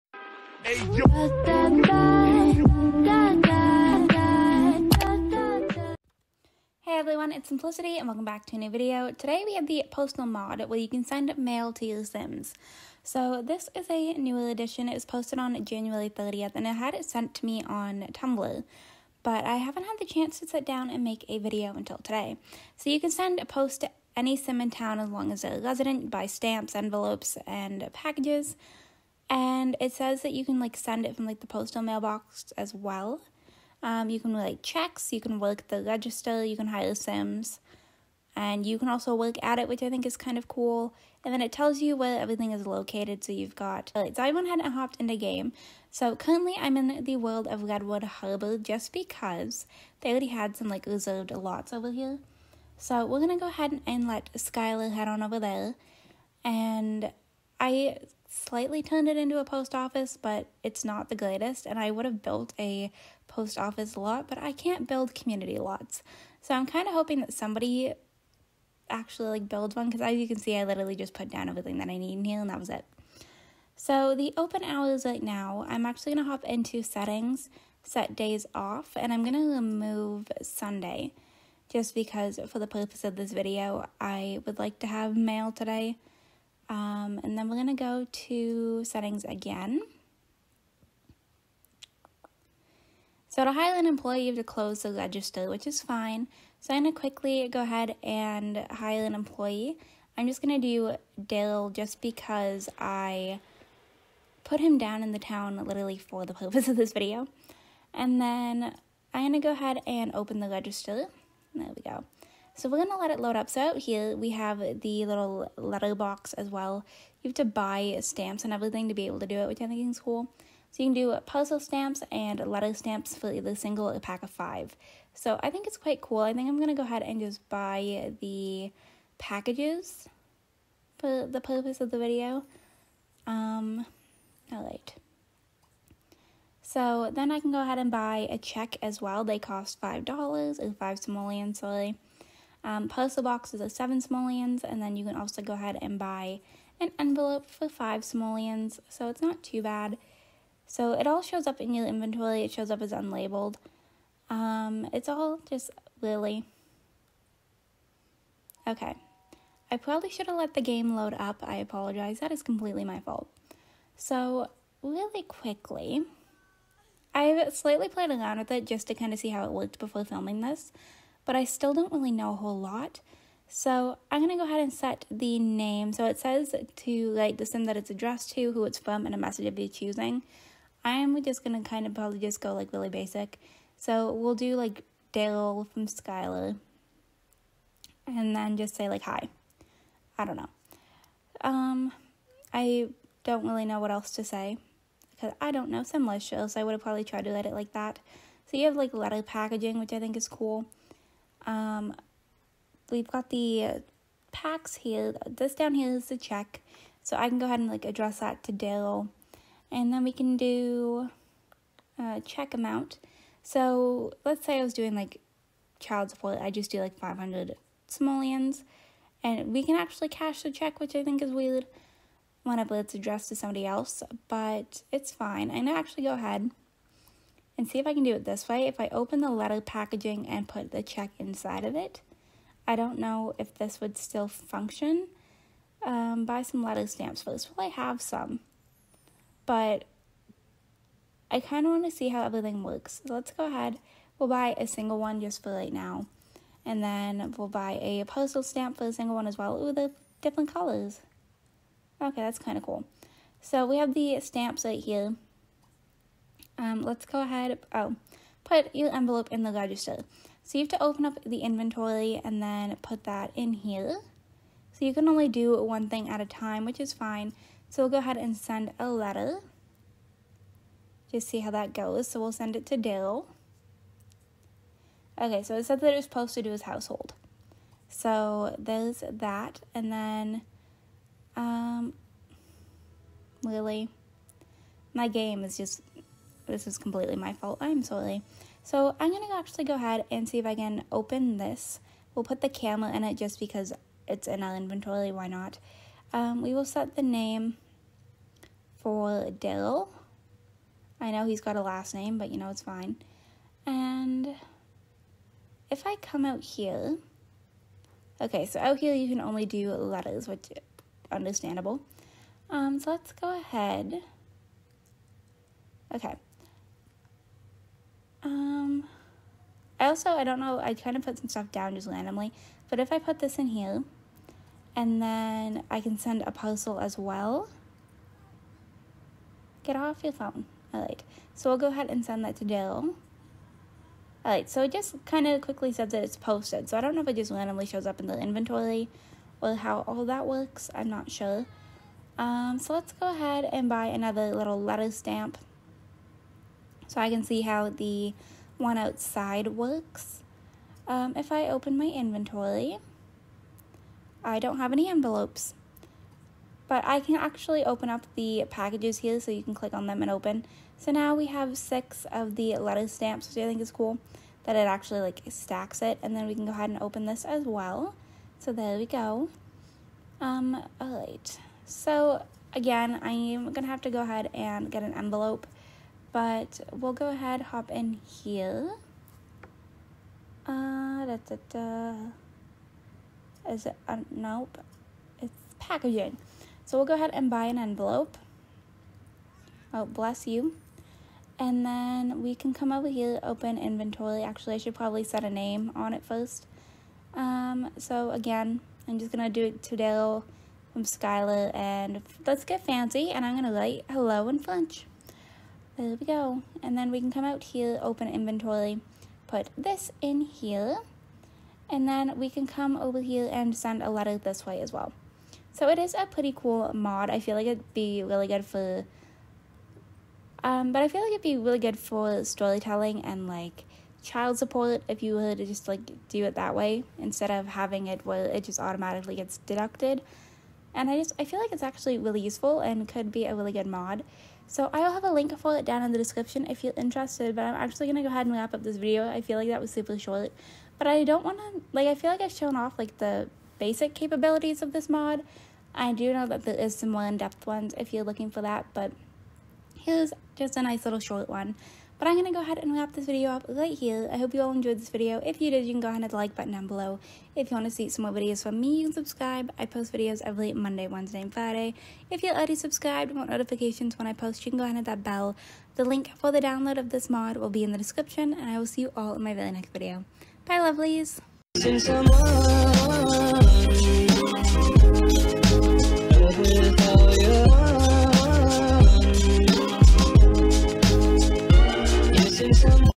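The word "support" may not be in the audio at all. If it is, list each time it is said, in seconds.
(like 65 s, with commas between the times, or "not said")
216 s, 424 s.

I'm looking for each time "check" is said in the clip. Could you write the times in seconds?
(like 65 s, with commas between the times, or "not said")
34 s, 138 s, 206 s, 212 s, 220 s, 230 s.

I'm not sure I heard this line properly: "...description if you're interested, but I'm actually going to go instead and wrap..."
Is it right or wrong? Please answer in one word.
wrong.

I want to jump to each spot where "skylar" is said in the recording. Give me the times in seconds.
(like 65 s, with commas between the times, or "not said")
54 s, 185 s, 400 s.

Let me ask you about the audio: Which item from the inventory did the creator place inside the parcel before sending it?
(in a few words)
camera.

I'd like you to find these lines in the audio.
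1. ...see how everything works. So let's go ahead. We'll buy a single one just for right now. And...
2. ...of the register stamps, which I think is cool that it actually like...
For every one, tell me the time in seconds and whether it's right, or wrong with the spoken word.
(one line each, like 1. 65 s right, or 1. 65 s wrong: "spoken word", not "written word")
1. 241 s right
2. 362 s wrong: "letter", not "register".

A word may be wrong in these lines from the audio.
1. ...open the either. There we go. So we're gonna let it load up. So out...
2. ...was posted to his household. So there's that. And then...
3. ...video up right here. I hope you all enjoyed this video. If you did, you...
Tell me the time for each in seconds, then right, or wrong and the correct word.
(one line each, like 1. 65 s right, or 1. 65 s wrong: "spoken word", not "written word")
1. 110 s wrong: "register", not "either"
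2. 275 s right
3. 453 s right.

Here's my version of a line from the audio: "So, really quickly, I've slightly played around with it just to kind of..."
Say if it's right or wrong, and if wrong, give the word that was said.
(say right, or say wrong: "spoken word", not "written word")
right.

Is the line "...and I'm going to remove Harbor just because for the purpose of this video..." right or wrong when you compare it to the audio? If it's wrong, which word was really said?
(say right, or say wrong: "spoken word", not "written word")
wrong: "Sunday", not "Harbor".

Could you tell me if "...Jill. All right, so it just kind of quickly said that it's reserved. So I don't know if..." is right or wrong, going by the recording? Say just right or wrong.
wrong.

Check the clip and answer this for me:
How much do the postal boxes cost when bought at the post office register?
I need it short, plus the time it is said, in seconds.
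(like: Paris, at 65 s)
7 simoleons, at 143 s.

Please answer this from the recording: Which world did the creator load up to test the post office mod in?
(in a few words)
Redwood Harbor.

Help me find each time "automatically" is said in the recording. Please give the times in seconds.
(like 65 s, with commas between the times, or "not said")
428 s.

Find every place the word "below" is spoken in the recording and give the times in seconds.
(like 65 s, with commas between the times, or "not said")
456 s.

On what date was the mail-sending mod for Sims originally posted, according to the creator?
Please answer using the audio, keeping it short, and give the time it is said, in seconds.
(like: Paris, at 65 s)
January 30th, at 15 s.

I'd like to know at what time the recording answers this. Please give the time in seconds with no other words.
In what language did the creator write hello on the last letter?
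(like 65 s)
404 s.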